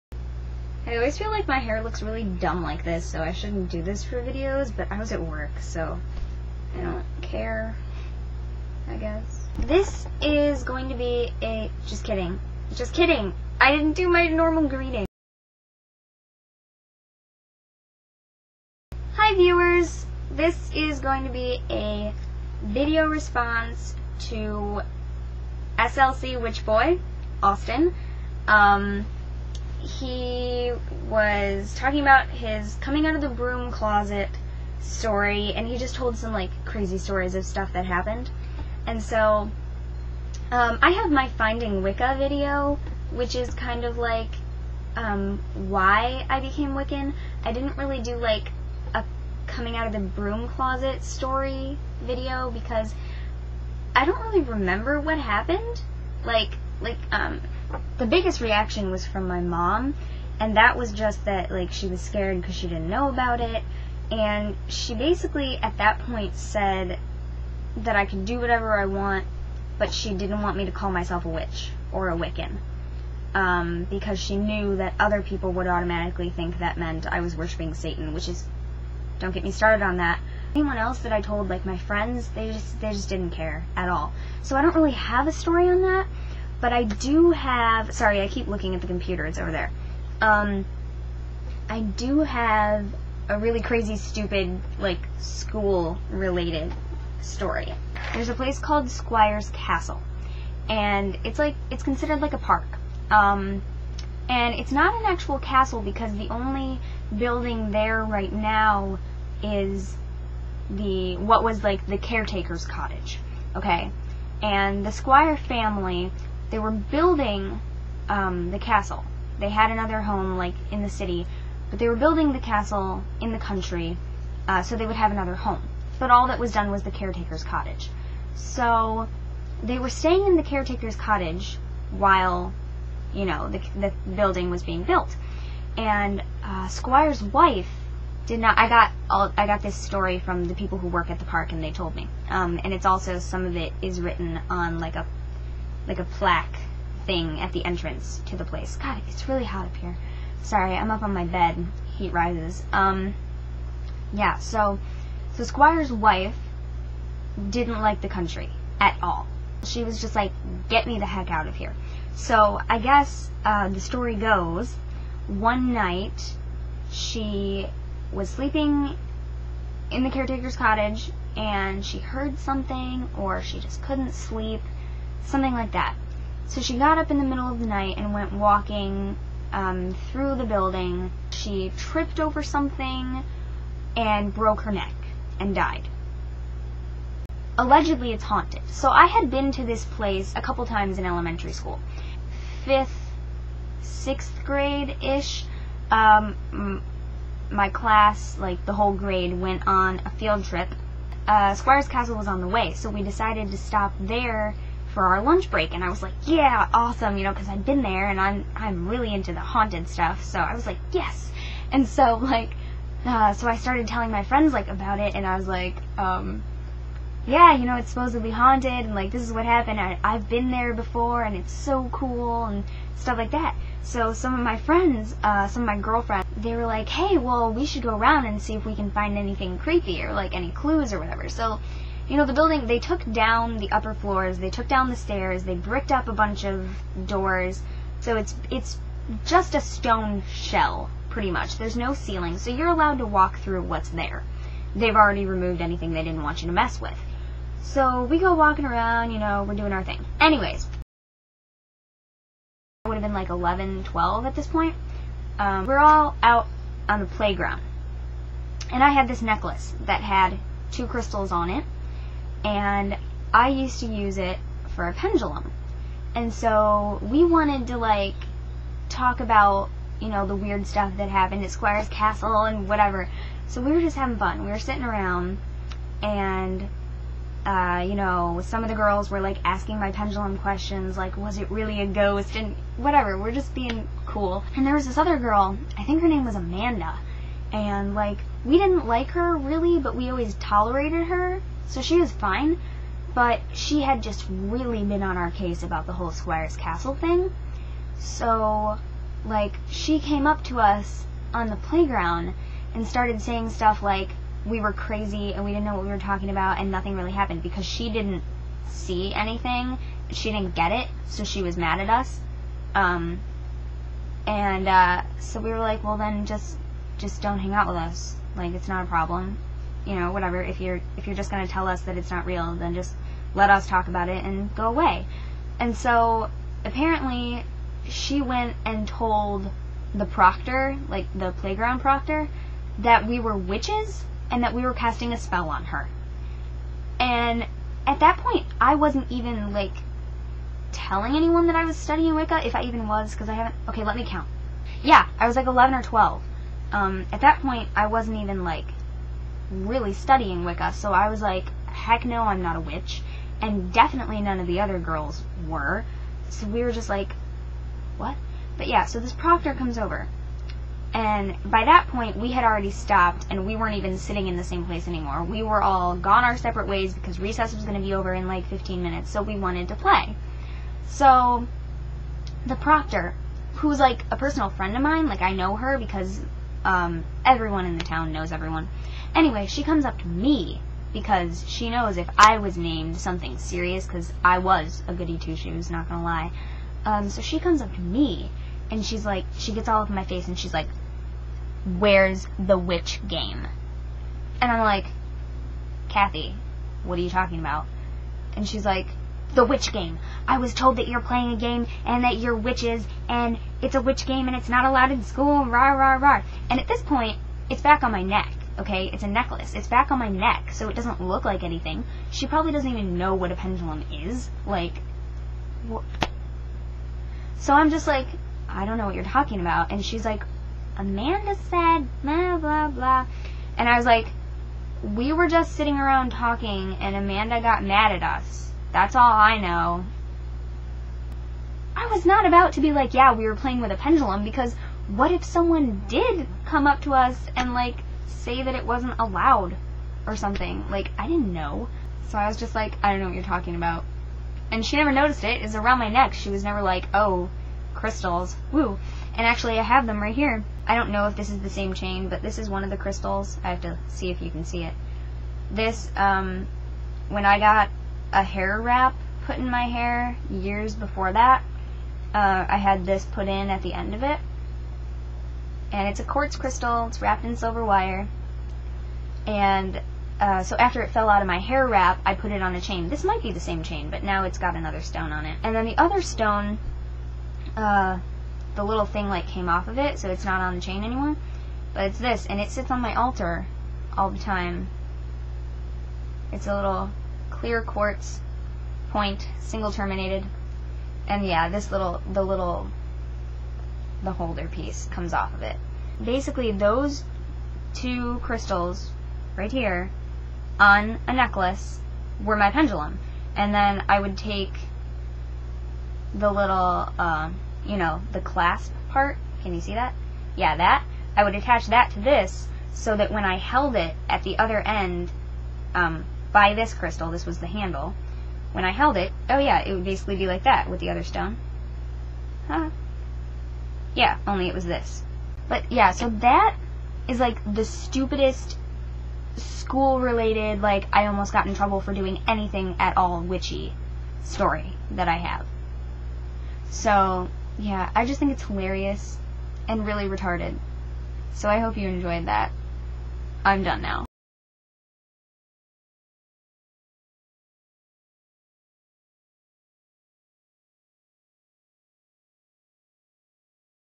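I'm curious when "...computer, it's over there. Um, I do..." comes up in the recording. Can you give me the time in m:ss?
1:28.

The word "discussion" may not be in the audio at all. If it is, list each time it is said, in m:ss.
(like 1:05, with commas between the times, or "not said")
not said.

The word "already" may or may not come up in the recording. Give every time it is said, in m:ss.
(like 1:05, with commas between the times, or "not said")
4:04, 6:02.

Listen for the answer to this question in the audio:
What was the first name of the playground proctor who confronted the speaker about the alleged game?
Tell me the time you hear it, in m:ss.
6:35.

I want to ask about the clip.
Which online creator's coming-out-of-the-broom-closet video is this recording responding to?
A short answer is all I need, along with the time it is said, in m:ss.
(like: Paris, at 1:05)
SLC Witch Boy, at 0:25.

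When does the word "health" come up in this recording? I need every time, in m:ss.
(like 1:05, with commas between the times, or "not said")
not said.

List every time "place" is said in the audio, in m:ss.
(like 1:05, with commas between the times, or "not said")
1:38, 2:28, 3:09, 6:04.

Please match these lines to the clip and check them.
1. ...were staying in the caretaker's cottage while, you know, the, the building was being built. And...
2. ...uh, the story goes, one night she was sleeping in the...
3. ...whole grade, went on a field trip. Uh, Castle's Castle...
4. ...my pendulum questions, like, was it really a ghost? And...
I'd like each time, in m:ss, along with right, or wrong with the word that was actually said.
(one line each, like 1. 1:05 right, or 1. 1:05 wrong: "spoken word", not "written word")
1. 2:09 right
2. 2:43 right
3. 3:18 wrong: "Squire", not "Castle"
4. 4:39 right.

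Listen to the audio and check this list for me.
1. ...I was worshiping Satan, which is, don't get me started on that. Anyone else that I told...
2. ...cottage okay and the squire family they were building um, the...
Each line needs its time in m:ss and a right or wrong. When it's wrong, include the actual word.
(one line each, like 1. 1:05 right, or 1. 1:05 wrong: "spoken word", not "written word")
1. 1:17 right
2. 1:52 right.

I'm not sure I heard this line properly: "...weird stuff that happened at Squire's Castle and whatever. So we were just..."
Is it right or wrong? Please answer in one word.
right.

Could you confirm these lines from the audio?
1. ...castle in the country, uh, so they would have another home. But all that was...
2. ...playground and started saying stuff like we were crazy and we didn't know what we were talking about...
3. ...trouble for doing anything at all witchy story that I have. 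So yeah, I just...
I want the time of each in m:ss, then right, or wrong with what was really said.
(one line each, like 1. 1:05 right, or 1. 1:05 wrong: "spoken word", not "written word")
1. 2:02 right
2. 5:01 right
3. 8:51 right.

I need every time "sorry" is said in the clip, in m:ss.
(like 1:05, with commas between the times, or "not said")
1:27, 2:30.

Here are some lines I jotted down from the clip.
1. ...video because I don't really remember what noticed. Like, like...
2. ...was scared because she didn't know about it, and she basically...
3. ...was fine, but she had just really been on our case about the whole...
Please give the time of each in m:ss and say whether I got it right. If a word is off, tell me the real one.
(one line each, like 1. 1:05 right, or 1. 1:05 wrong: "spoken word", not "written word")
1. 0:52 wrong: "happened", not "noticed"
2. 1:01 right
3. 4:51 right.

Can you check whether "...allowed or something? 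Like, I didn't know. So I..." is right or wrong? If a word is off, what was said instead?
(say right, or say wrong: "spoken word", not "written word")
right.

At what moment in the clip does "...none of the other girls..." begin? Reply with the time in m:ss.
5:54.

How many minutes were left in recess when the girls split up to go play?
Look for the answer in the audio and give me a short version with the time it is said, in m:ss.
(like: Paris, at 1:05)
15, at 6:08.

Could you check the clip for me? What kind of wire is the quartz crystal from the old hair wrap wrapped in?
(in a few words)
silver.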